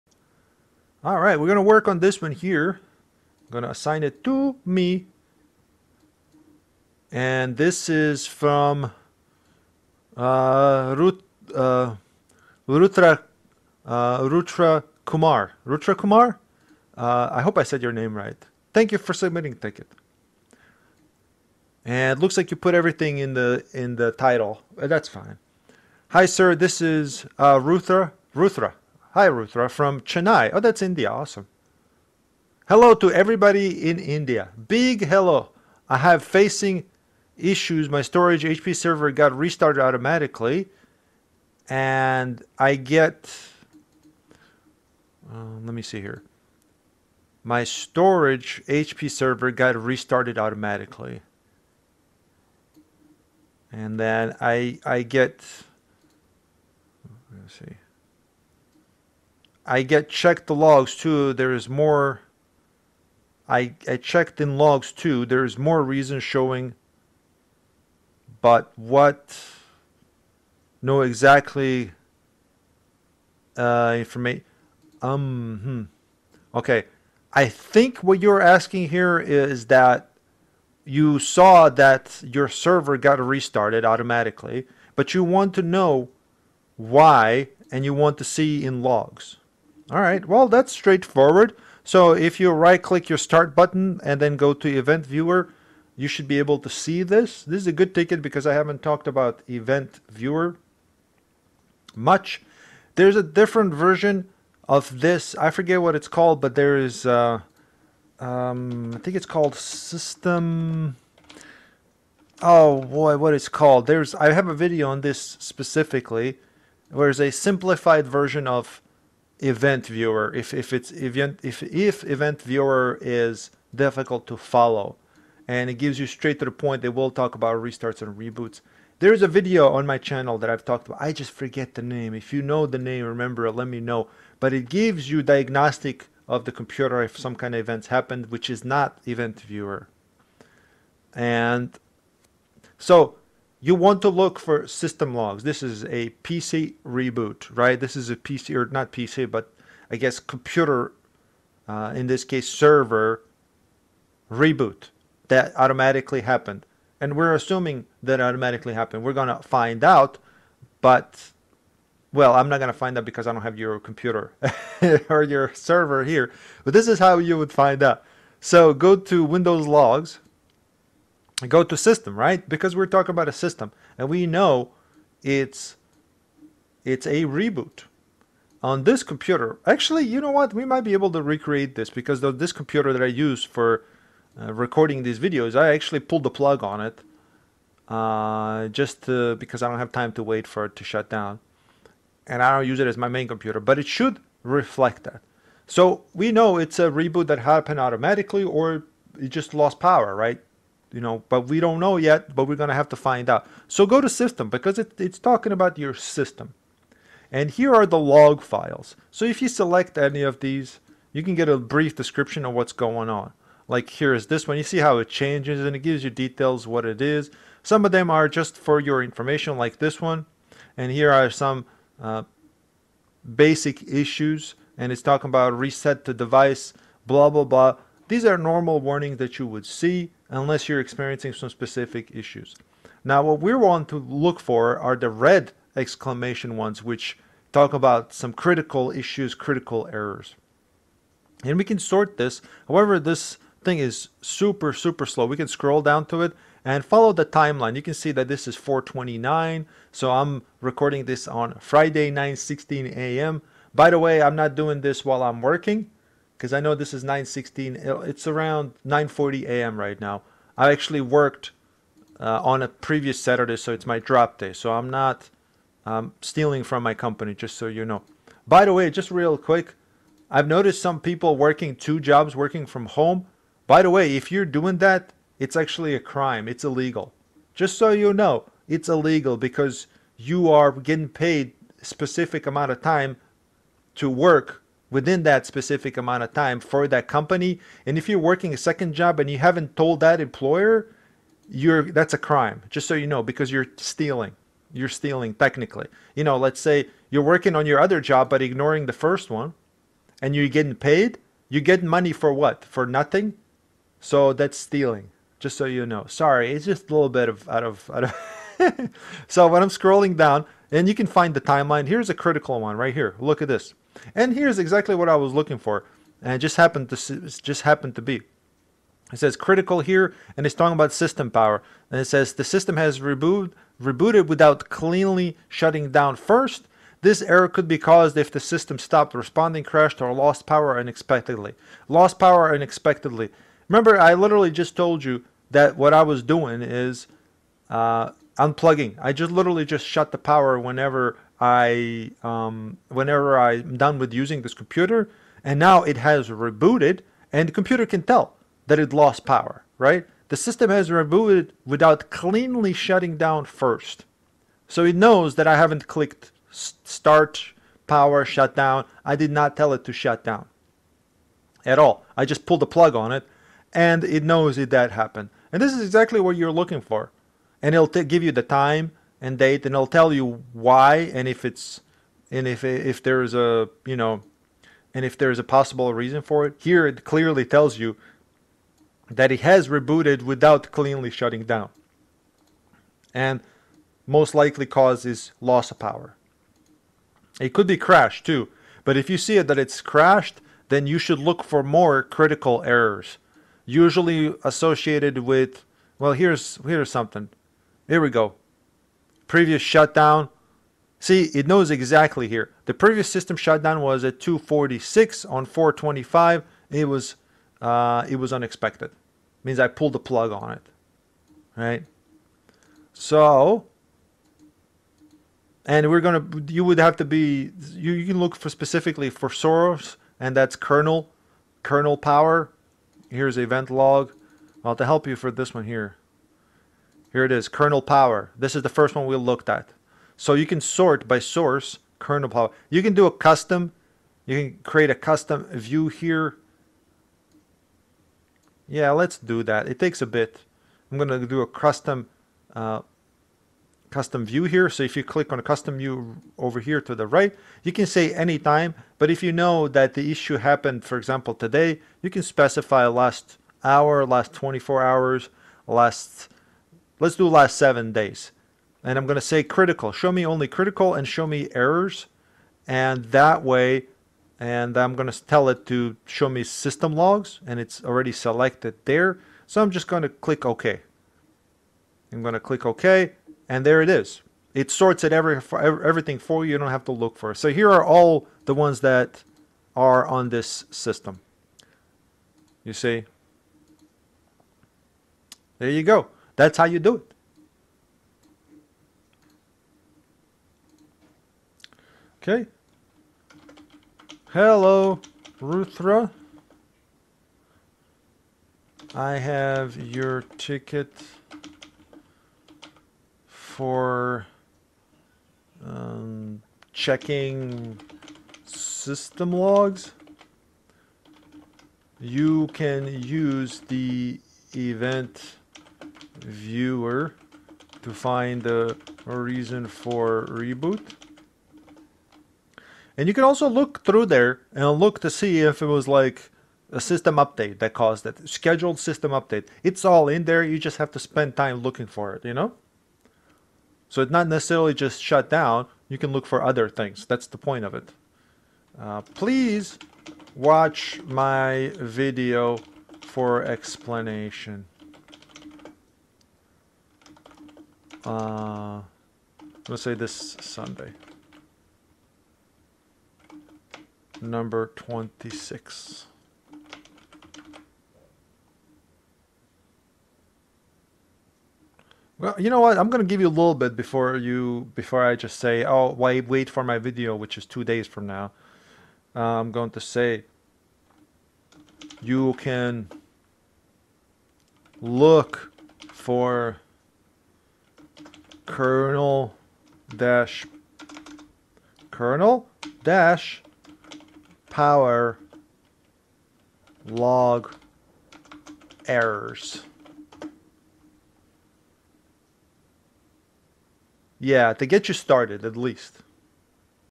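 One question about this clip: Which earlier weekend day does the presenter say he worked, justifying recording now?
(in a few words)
Saturday.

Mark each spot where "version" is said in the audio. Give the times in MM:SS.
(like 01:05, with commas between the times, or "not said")
01:43, 01:58.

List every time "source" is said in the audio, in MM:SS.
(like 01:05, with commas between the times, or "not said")
06:59, 07:11.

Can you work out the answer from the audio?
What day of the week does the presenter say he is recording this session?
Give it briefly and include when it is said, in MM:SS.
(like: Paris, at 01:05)
Friday, at 04:11.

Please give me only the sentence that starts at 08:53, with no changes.
So it's not necessarily just shut down.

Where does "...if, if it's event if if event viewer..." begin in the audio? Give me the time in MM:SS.
02:00.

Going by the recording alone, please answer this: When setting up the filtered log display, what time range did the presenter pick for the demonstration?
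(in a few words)
last seven days.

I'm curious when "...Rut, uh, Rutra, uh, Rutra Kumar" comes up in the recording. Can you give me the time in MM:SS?
00:10.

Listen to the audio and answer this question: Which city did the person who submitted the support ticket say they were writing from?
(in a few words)
Chennai.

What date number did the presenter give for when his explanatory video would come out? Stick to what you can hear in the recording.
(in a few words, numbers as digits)
26.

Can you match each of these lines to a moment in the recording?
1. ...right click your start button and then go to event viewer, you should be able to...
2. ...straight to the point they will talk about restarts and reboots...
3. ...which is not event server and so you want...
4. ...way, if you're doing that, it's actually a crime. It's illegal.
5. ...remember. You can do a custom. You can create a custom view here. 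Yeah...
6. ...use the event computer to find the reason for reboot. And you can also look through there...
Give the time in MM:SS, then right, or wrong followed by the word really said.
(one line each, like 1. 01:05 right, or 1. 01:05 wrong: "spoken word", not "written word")
1. 01:32 right
2. 02:06 right
3. 02:18 wrong: "viewer", not "server"
4. 04:33 right
5. 07:12 wrong: "power", not "remember"
6. 08:33 wrong: "viewer", not "computer".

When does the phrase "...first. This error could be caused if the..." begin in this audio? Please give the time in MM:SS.
05:26.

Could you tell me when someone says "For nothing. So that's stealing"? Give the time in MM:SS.
05:02.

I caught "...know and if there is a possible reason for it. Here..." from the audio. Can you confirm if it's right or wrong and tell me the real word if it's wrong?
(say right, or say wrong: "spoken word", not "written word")
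right.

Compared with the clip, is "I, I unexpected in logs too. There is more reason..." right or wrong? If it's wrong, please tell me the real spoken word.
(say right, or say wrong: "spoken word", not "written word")
wrong: "checked", not "unexpected".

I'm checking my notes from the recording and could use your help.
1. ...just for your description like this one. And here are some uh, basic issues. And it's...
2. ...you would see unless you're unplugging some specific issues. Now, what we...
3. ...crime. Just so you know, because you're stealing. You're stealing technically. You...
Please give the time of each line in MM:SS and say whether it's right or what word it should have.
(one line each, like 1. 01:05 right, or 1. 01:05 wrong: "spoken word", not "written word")
1. 03:38 wrong: "information", not "description"
2. 03:49 wrong: "experiencing", not "unplugging"
3. 04:52 right.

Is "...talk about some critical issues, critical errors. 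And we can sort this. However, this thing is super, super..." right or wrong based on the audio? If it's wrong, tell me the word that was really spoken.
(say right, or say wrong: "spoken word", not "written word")
right.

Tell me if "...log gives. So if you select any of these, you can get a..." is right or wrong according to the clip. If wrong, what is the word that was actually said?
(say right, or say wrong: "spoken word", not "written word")
wrong: "files", not "gives".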